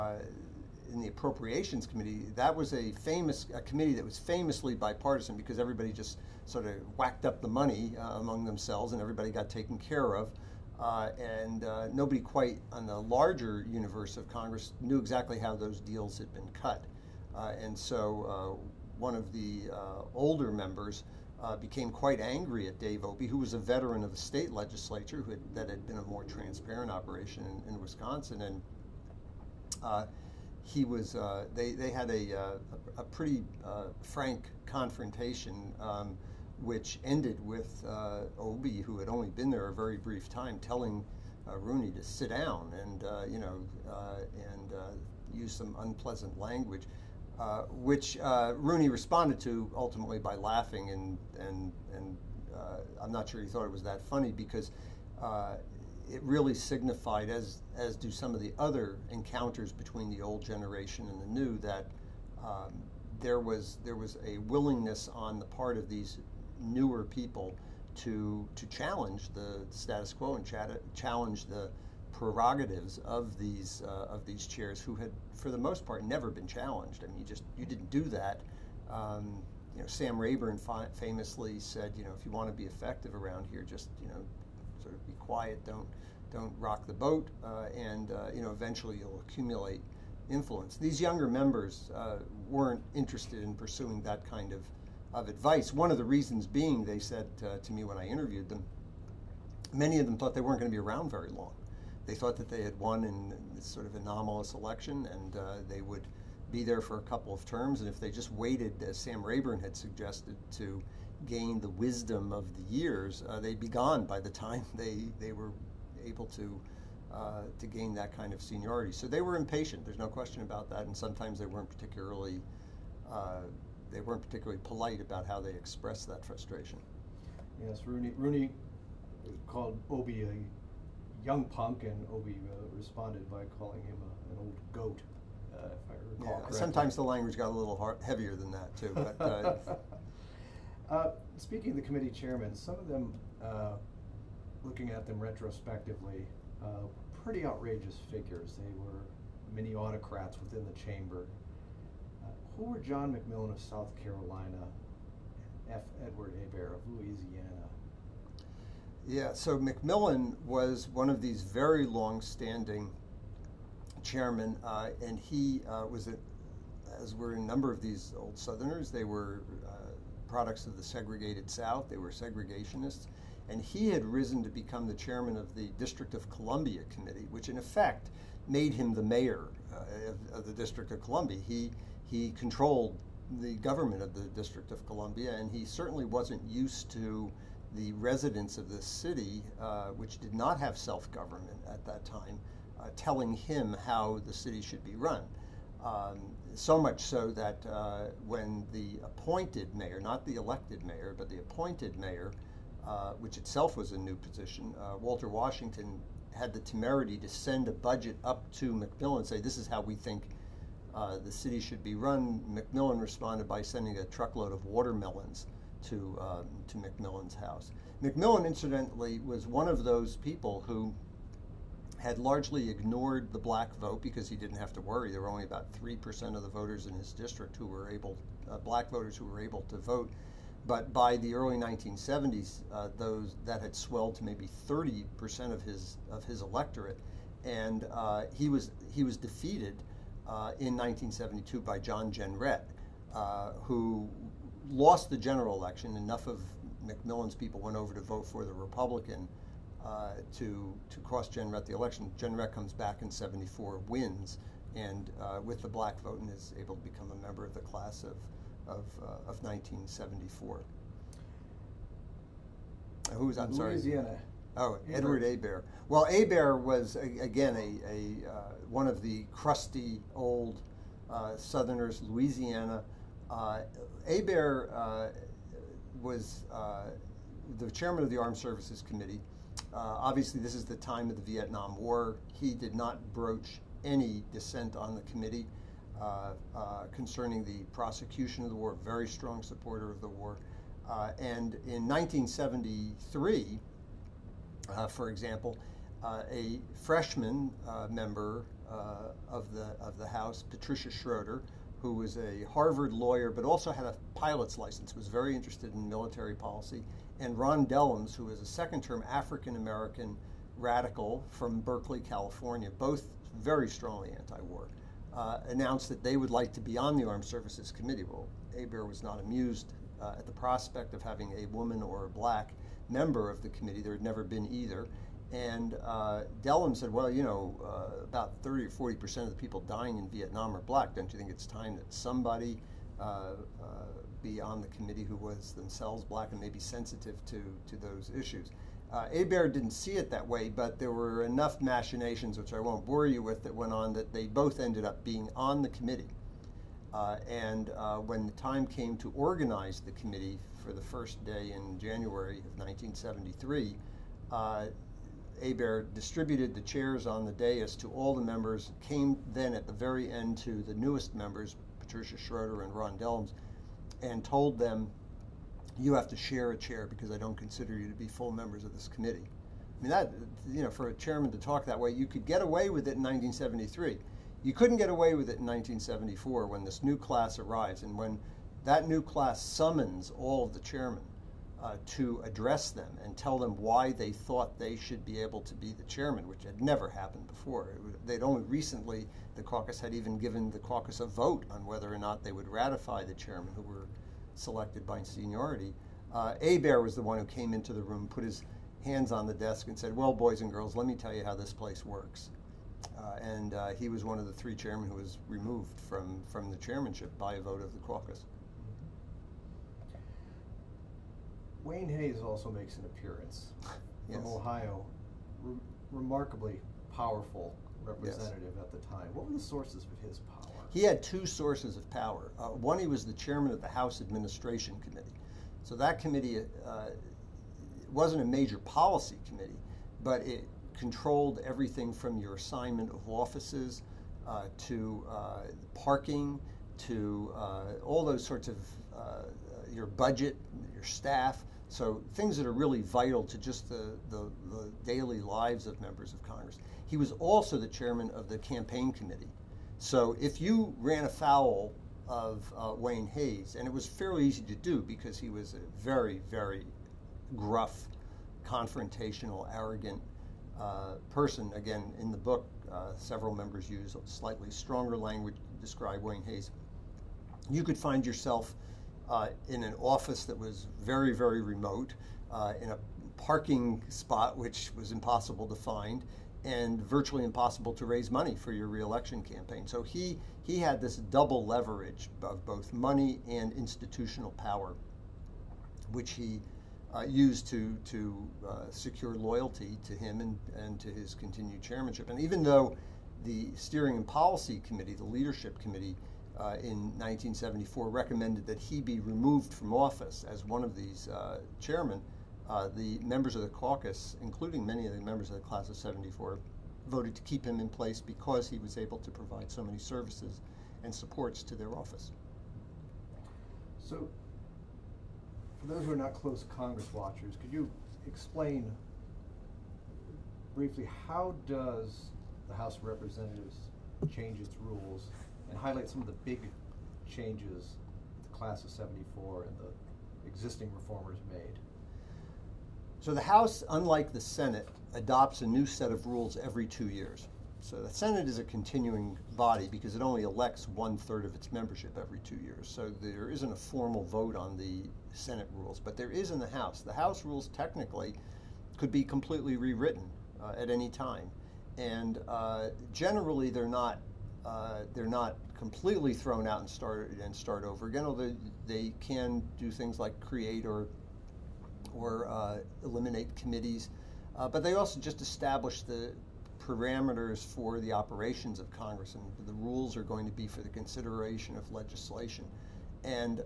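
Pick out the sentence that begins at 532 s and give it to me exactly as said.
So the House, unlike the Senate, adopts a new set of rules every two years.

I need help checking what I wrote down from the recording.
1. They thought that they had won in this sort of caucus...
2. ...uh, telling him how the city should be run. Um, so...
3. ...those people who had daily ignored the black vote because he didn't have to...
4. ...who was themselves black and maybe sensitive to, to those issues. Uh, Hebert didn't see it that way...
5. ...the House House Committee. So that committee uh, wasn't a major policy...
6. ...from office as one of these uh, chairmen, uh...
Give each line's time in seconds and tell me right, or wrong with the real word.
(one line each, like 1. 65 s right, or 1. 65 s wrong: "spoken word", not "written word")
1. 102 s wrong: "anomalous", not "caucus"
2. 192 s right
3. 219 s wrong: "largely", not "daily"
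4. 335 s right
5. 423 s wrong: "Administration", not "House"
6. 499 s right.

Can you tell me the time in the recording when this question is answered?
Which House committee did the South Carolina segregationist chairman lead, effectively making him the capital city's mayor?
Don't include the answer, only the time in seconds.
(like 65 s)
175 s.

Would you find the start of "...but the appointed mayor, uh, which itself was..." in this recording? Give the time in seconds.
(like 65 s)
201 s.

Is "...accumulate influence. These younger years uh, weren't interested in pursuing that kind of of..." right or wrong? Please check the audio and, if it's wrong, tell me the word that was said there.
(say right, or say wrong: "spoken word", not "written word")
wrong: "members", not "years".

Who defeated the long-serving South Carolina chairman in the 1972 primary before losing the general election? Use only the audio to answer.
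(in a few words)
John Jenrette.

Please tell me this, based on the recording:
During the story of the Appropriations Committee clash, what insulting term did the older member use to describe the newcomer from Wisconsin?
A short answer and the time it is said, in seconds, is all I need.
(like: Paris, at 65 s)
young punk, at 131 s.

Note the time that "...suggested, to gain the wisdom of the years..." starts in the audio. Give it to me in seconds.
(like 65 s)
109 s.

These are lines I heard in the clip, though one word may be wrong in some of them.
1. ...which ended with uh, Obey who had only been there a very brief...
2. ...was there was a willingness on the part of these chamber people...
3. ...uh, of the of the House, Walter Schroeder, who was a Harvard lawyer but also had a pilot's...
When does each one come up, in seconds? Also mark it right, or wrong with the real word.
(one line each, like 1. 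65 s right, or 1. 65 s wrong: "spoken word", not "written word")
1. 36 s right
2. 63 s wrong: "newer", not "chamber"
3. 298 s wrong: "Patricia", not "Walter".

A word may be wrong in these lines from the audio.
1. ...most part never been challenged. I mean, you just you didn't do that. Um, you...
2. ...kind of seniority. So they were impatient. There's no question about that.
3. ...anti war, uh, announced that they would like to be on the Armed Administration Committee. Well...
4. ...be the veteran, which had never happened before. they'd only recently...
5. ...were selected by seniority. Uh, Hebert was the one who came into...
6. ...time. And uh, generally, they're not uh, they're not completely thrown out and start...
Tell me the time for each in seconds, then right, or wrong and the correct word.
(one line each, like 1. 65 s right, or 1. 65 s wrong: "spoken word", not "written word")
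1. 75 s right
2. 118 s right
3. 314 s wrong: "Services", not "Administration"
4. 385 s wrong: "chairman", not "veteran"
5. 393 s right
6. 550 s right.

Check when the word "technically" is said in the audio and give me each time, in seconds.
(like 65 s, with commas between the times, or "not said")
547 s.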